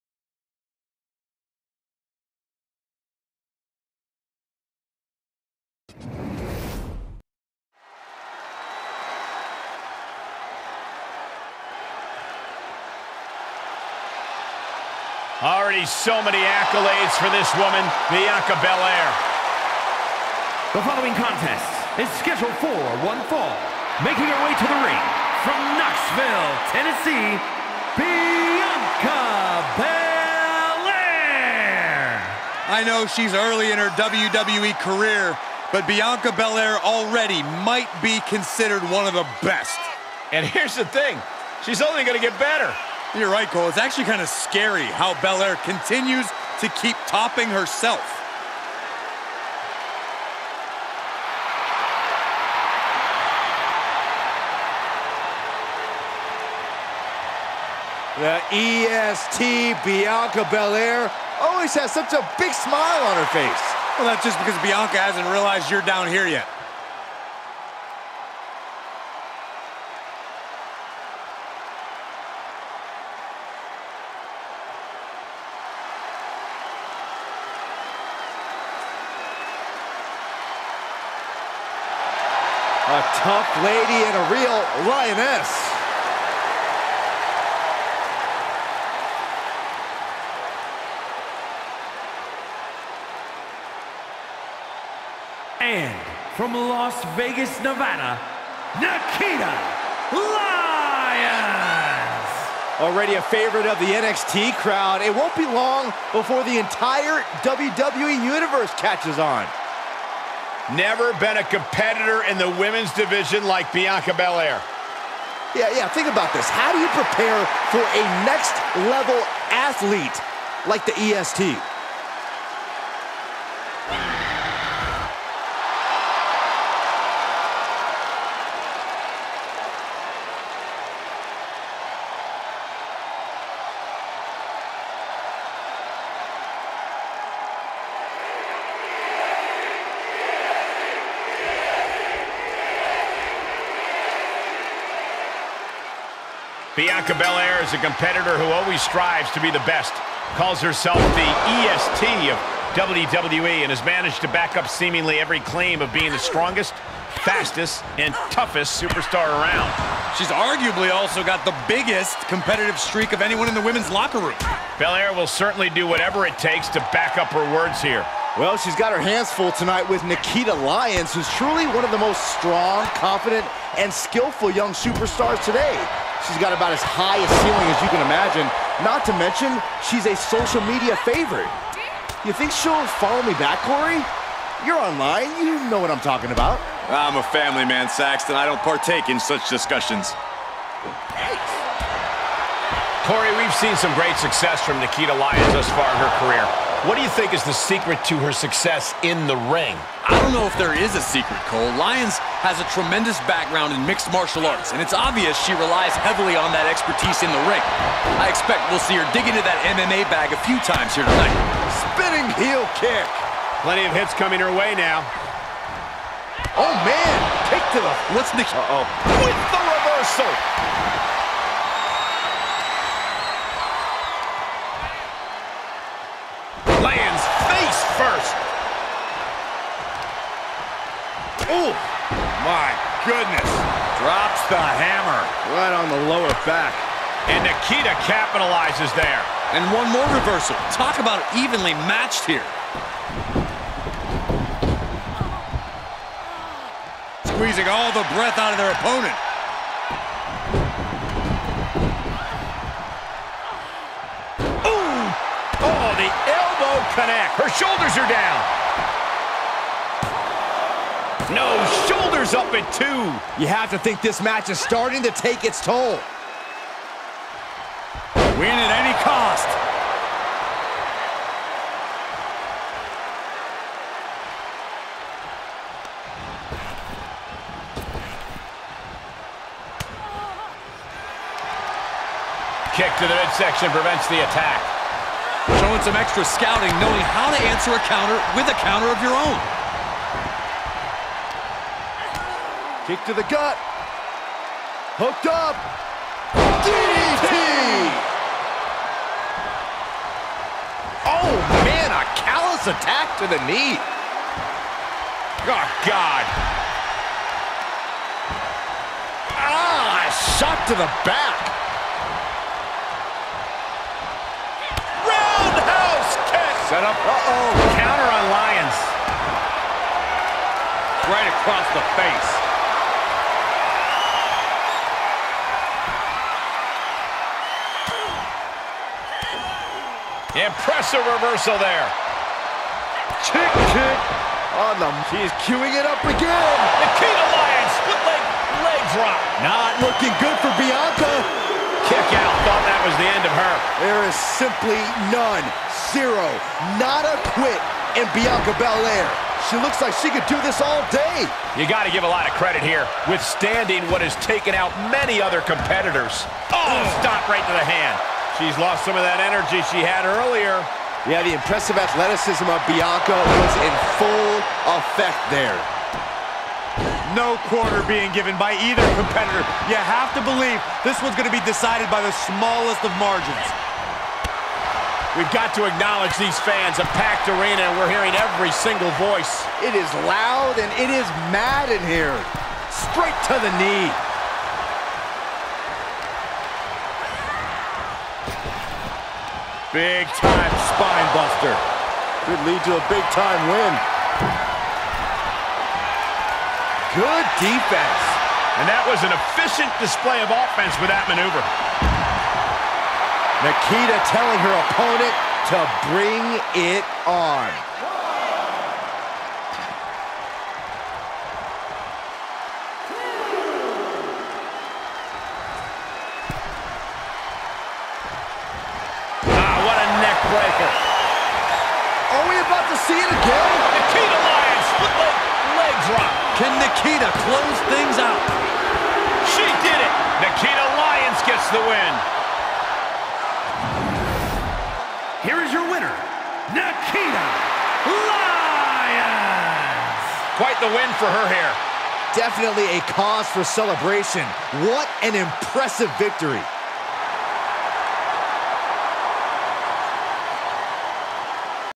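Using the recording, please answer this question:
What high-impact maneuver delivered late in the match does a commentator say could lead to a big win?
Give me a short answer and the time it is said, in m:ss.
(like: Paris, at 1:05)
Spine buster, at 6:30.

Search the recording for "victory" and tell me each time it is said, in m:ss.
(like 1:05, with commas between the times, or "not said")
7:25.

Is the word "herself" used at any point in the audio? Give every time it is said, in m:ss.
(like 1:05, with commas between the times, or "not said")
0:47, 2:30.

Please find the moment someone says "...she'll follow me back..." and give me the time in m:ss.
3:02.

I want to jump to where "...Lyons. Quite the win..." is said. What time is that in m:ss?
7:17.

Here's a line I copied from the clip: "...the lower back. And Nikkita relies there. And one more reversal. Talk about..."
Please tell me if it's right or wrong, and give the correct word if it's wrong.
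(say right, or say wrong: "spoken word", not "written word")
wrong: "capitalizes", not "relies".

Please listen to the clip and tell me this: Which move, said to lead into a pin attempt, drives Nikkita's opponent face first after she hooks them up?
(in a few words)
DDT.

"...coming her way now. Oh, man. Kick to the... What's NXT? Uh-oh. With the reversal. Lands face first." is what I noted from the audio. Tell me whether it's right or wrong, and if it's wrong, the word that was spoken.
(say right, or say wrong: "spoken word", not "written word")
wrong: "Nikki", not "NXT".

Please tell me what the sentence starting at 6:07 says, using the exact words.
No quarter being given by either competitor.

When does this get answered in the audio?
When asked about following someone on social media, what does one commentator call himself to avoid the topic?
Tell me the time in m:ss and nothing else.
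3:07.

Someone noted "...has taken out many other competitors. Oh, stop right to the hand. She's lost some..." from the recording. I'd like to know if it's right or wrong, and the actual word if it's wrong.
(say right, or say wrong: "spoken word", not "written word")
right.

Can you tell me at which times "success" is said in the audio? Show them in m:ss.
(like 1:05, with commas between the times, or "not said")
3:14, 3:18.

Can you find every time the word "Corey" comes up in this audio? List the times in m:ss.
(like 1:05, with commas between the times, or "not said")
3:03, 3:13.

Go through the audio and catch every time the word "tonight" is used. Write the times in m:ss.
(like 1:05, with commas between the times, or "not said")
2:49, 3:31.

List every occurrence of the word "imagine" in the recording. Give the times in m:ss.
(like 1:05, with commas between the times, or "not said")
2:58.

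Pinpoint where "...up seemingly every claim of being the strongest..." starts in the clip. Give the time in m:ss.
2:34.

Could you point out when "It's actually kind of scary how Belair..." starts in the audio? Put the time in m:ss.
0:43.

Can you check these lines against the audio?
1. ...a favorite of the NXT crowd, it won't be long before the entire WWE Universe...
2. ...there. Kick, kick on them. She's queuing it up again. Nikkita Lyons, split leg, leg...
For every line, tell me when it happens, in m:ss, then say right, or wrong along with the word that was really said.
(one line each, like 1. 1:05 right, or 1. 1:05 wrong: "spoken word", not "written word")
1. 1:43 right
2. 5:31 right.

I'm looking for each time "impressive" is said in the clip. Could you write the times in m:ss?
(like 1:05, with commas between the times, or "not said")
5:30, 6:01, 7:25.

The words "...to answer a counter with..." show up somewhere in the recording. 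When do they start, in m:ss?
4:47.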